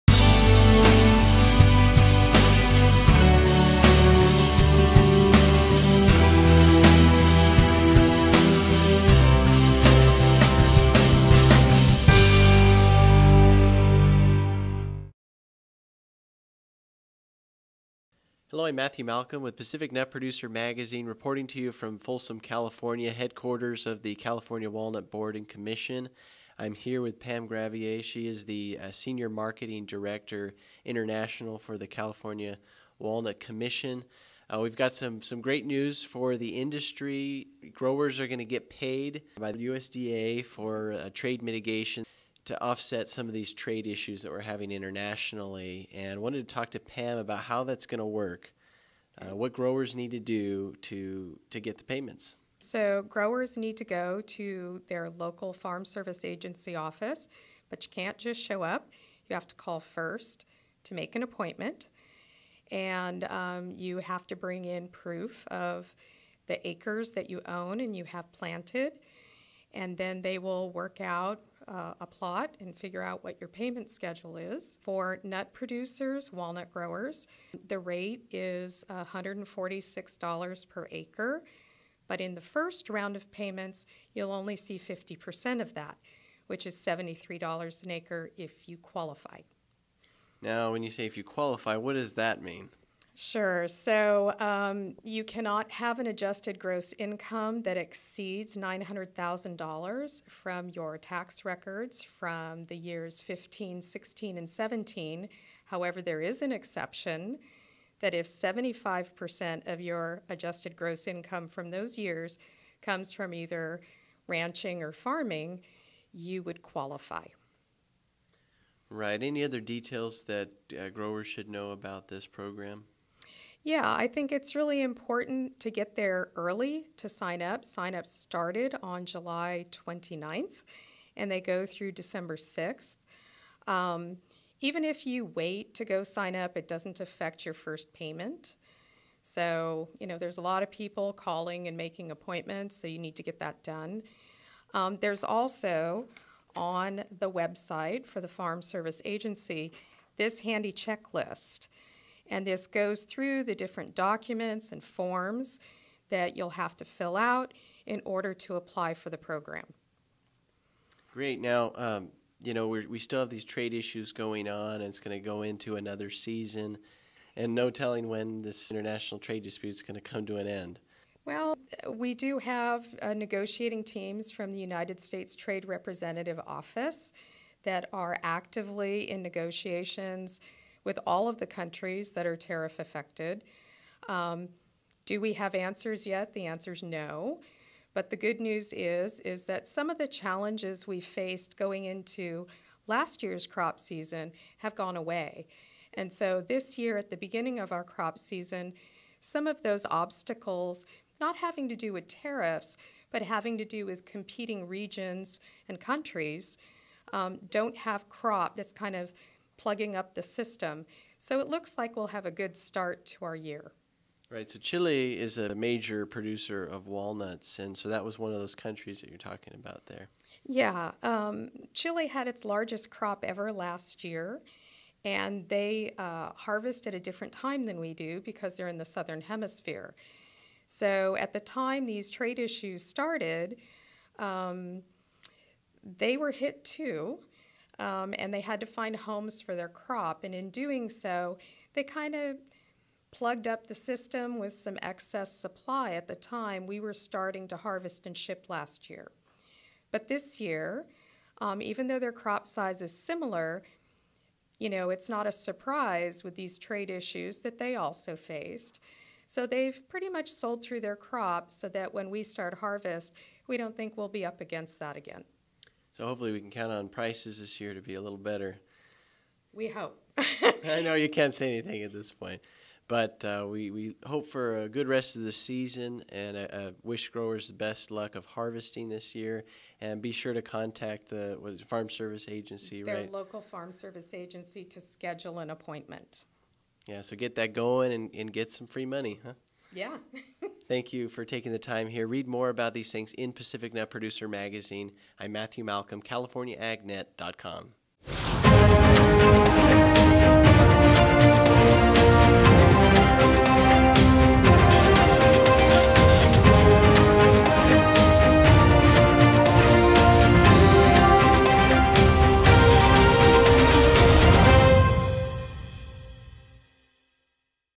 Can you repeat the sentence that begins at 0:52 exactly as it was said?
So growers need to go to their local farm service agency office, but you can't just show up.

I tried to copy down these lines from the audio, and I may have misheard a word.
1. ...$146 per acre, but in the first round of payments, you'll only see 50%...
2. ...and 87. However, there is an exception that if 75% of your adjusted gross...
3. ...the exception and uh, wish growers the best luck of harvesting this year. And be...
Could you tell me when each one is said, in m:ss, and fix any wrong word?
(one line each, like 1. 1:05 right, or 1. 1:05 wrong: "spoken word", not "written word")
1. 1:18 right
2. 1:44 wrong: "17", not "87"
3. 4:35 wrong: "season", not "exception".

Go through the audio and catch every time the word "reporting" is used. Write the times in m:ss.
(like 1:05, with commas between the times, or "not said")
0:21.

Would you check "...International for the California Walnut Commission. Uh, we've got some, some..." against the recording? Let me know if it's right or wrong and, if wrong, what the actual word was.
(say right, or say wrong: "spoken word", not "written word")
right.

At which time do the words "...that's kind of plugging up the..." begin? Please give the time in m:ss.
3:28.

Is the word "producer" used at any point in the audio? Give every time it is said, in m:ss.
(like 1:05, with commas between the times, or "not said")
0:20, 1:15, 3:36, 4:53.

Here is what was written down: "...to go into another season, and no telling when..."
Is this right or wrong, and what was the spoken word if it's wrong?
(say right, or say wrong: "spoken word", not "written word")
right.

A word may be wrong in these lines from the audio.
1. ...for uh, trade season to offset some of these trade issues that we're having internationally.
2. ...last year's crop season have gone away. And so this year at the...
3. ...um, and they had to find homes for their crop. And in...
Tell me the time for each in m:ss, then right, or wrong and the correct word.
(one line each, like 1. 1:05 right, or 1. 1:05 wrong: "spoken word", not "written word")
1. 0:40 wrong: "mitigation", not "season"
2. 3:12 right
3. 3:57 right.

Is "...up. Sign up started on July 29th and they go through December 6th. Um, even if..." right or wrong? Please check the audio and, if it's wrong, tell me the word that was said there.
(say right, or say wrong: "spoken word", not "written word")
right.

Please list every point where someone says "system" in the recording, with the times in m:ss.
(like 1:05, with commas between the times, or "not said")
3:30, 4:03.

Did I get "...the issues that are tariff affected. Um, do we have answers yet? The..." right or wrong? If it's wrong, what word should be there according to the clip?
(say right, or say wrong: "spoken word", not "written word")
wrong: "countries", not "issues".